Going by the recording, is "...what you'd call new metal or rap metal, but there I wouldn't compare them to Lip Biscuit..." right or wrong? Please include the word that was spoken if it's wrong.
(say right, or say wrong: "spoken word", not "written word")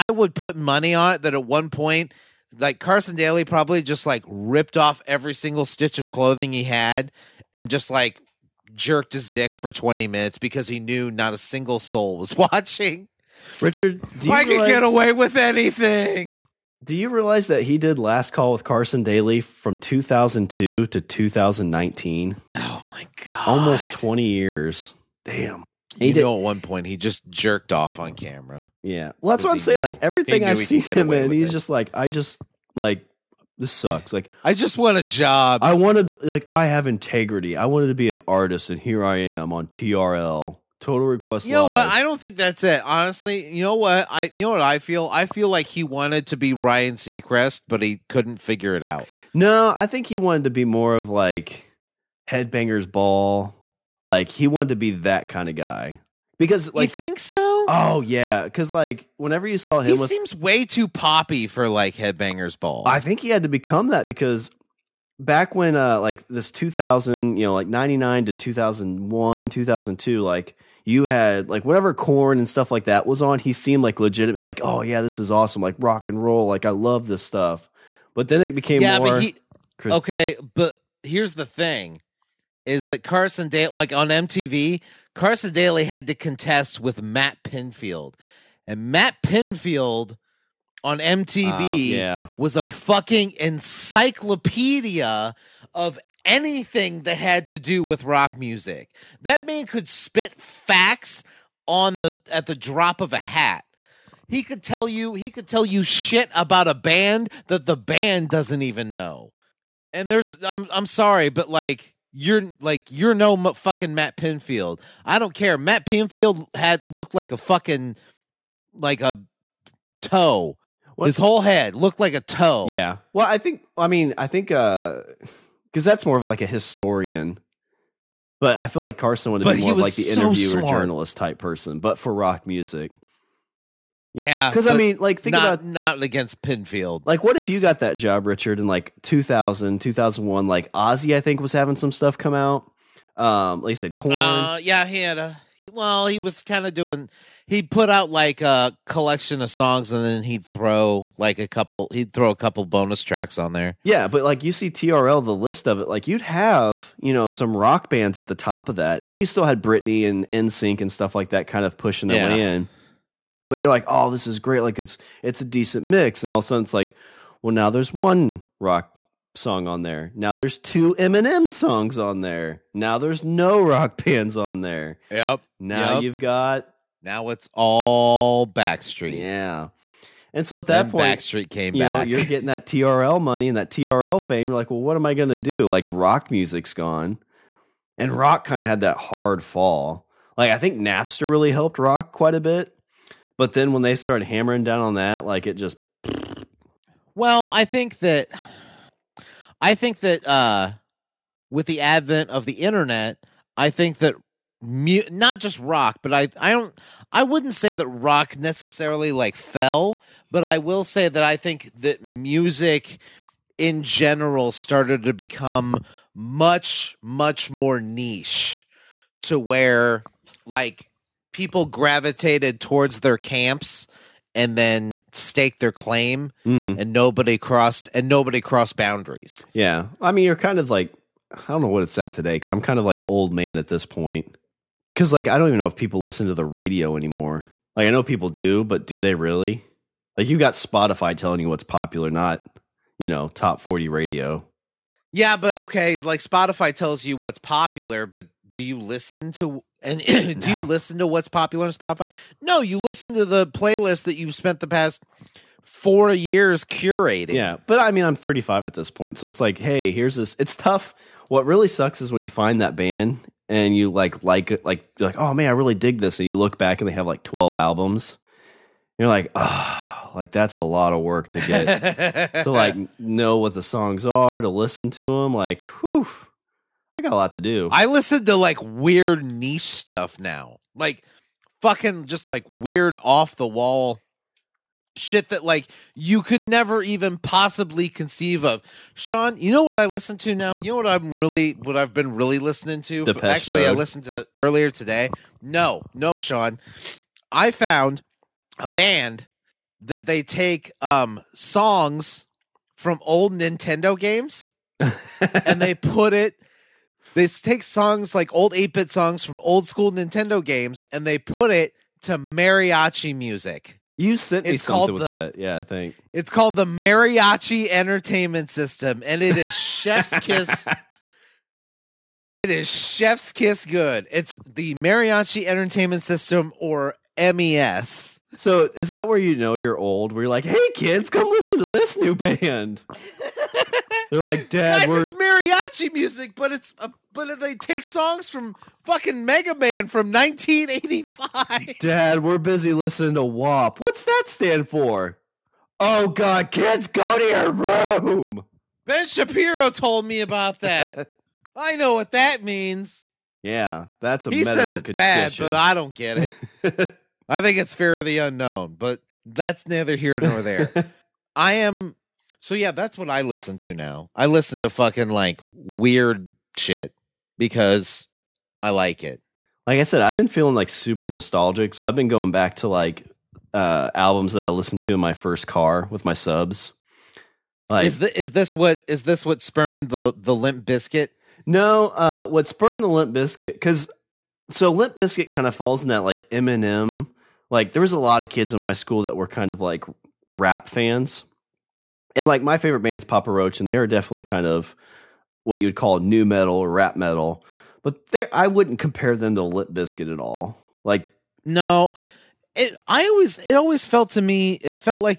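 right.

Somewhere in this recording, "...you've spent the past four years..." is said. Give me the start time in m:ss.
4:14.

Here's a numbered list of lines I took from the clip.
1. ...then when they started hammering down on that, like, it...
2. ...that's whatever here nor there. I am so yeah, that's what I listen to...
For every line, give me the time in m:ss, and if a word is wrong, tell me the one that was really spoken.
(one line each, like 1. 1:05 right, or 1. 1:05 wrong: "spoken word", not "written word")
1. 3:13 right
2. 5:59 wrong: "neither", not "whatever".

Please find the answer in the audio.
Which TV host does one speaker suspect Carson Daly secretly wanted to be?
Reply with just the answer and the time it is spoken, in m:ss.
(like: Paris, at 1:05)
Ryan Seacrest, at 0:46.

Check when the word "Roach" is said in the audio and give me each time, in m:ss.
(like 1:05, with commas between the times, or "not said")
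6:33.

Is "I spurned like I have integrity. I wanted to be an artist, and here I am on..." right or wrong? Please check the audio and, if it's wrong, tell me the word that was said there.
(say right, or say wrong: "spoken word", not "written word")
wrong: "wanted", not "spurned".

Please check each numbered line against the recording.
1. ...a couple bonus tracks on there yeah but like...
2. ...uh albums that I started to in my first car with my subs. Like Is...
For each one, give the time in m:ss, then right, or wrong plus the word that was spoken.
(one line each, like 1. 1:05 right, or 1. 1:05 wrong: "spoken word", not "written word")
1. 2:32 right
2. 6:13 wrong: "listened", not "started".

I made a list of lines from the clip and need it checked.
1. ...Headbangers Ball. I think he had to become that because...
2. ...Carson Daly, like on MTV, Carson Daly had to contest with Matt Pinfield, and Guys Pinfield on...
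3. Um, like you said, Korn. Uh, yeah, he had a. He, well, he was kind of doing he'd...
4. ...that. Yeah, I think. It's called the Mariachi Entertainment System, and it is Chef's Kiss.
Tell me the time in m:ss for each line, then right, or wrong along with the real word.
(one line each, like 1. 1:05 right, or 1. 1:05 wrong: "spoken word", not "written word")
1. 1:01 right
2. 1:23 wrong: "Matt", not "Guys"
3. 2:23 right
4. 5:15 right.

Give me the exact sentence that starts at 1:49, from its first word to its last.
And there's I'm I'm sorry, but like you're like you're no fucking Matt Pinfield.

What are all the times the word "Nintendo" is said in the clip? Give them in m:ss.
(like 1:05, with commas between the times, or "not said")
5:03, 5:09.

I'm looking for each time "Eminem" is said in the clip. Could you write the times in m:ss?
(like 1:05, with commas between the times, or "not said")
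2:50, 6:26.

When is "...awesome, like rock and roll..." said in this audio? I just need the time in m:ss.
1:15.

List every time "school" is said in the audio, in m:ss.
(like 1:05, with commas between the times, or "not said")
5:09, 6:28.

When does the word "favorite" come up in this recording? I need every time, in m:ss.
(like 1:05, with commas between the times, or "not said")
6:32.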